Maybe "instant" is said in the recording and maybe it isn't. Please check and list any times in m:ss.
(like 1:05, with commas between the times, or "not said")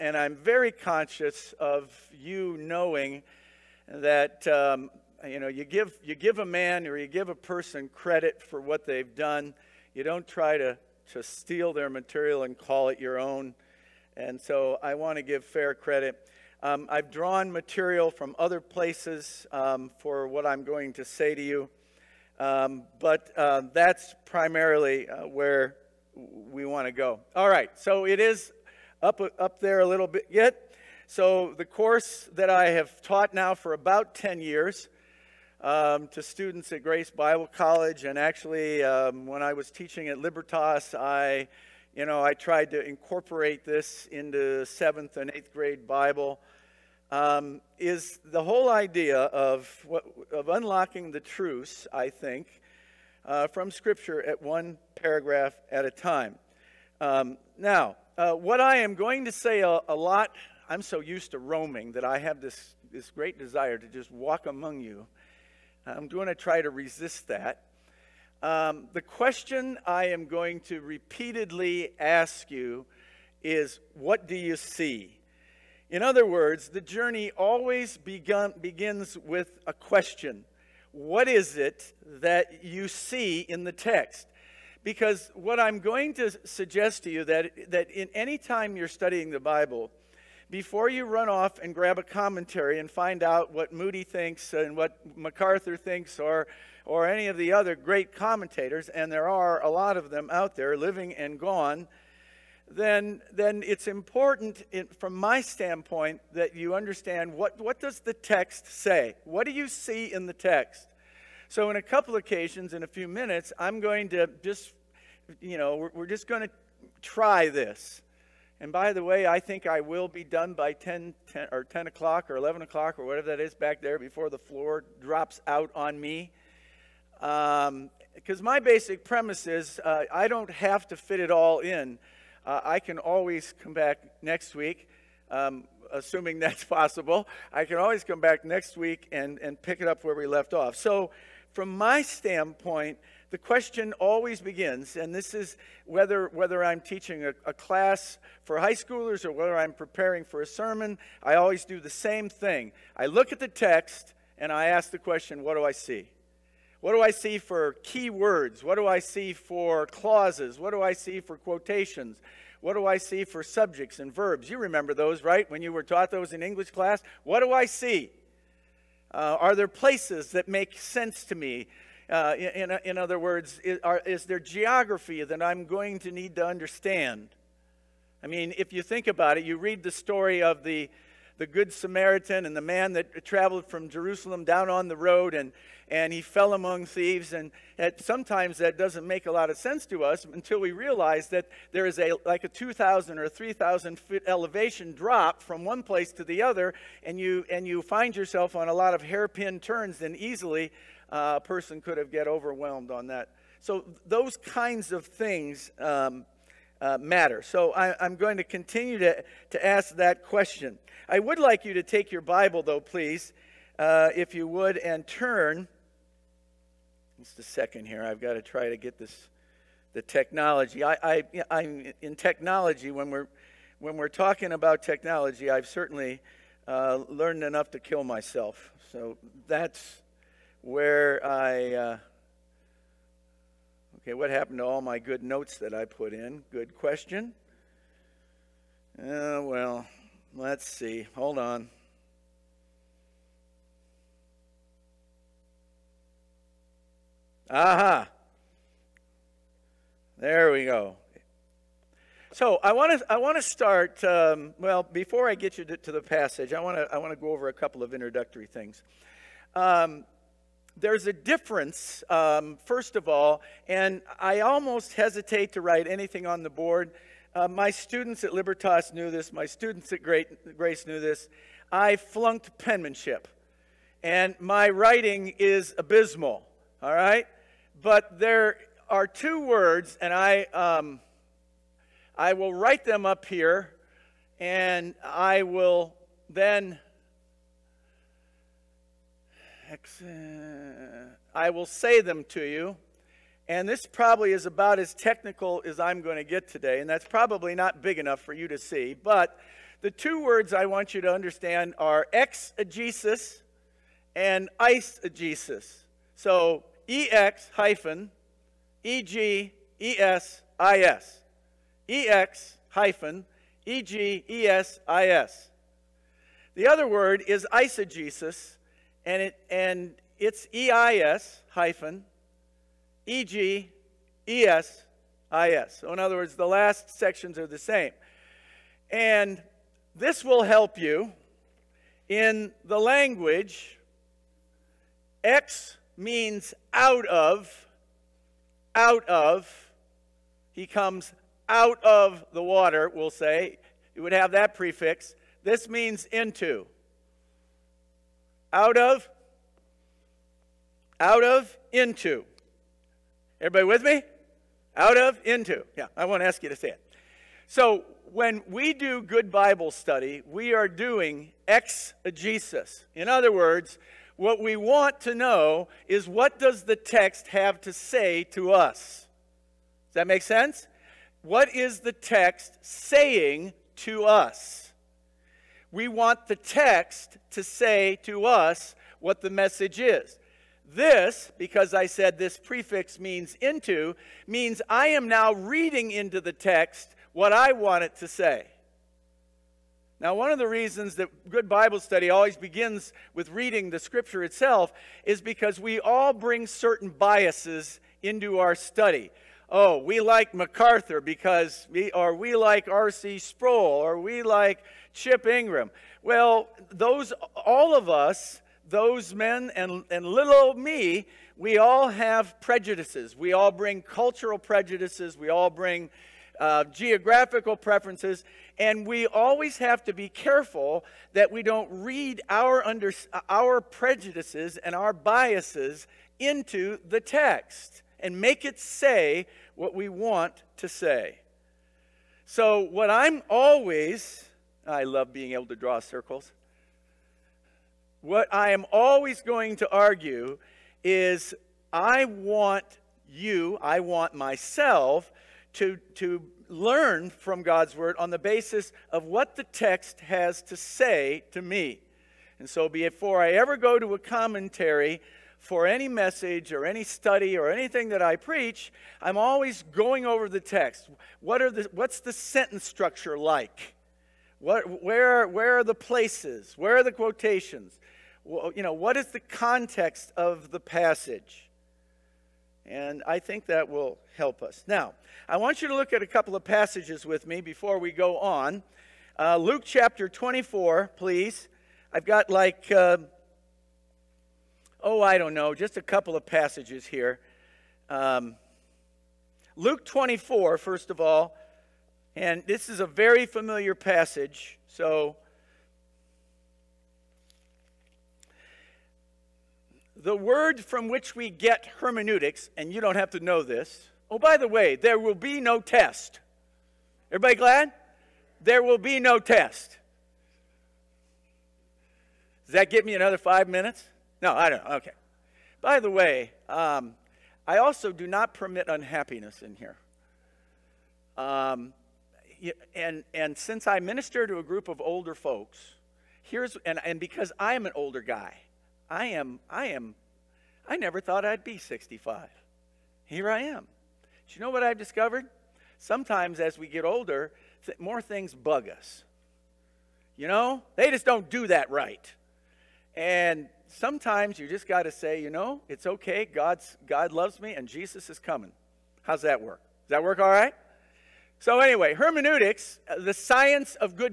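not said.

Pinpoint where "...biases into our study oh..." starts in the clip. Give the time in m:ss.
6:36.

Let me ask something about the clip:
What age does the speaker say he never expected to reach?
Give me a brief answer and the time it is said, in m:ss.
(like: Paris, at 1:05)
65, at 8:51.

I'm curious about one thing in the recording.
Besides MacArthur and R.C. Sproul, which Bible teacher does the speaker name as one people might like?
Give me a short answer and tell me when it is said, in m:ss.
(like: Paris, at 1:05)
Chip Ingram, at 6:44.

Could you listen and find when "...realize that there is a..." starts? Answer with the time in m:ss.
3:10.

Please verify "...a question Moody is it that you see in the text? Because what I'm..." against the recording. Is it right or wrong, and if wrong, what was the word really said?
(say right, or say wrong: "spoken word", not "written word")
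wrong: "What", not "Moody".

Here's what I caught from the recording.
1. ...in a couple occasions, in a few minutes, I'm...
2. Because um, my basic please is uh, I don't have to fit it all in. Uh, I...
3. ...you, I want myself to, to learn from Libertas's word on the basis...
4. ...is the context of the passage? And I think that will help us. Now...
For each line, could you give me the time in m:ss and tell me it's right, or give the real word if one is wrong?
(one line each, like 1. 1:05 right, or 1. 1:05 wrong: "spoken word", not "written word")
1. 1:51 right
2. 2:07 wrong: "premise", not "please"
3. 7:23 wrong: "God", not "Libertas"
4. 7:48 right.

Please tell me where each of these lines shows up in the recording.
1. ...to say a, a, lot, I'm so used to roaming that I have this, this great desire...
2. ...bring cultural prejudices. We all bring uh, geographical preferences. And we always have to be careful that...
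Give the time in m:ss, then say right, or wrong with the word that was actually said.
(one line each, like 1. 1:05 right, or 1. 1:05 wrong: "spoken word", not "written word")
1. 0:59 right
2. 6:53 right.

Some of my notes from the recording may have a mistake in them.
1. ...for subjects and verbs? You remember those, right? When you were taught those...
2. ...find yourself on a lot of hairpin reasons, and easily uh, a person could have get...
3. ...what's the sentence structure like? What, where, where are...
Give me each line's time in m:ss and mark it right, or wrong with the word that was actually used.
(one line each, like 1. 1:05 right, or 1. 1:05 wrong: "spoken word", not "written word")
1. 2:43 right
2. 3:17 wrong: "turns", not "reasons"
3. 7:41 right.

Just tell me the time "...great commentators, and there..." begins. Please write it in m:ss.
1:37.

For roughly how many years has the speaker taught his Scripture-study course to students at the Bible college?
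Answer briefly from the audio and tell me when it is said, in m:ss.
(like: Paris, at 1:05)
10, at 0:33.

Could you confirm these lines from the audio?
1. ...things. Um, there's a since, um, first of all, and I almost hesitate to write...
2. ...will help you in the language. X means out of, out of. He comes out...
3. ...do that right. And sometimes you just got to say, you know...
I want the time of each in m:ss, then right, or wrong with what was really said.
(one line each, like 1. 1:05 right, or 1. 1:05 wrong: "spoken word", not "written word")
1. 4:18 wrong: "difference", not "since"
2. 5:30 right
3. 9:01 right.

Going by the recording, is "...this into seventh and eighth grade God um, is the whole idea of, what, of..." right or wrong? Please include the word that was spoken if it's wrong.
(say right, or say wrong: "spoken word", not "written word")
wrong: "Bible", not "God".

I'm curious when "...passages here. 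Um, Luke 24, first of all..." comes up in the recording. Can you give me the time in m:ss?
8:06.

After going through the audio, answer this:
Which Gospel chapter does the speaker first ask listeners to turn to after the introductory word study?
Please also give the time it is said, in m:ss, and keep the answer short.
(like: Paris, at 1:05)
Luke 24, at 7:59.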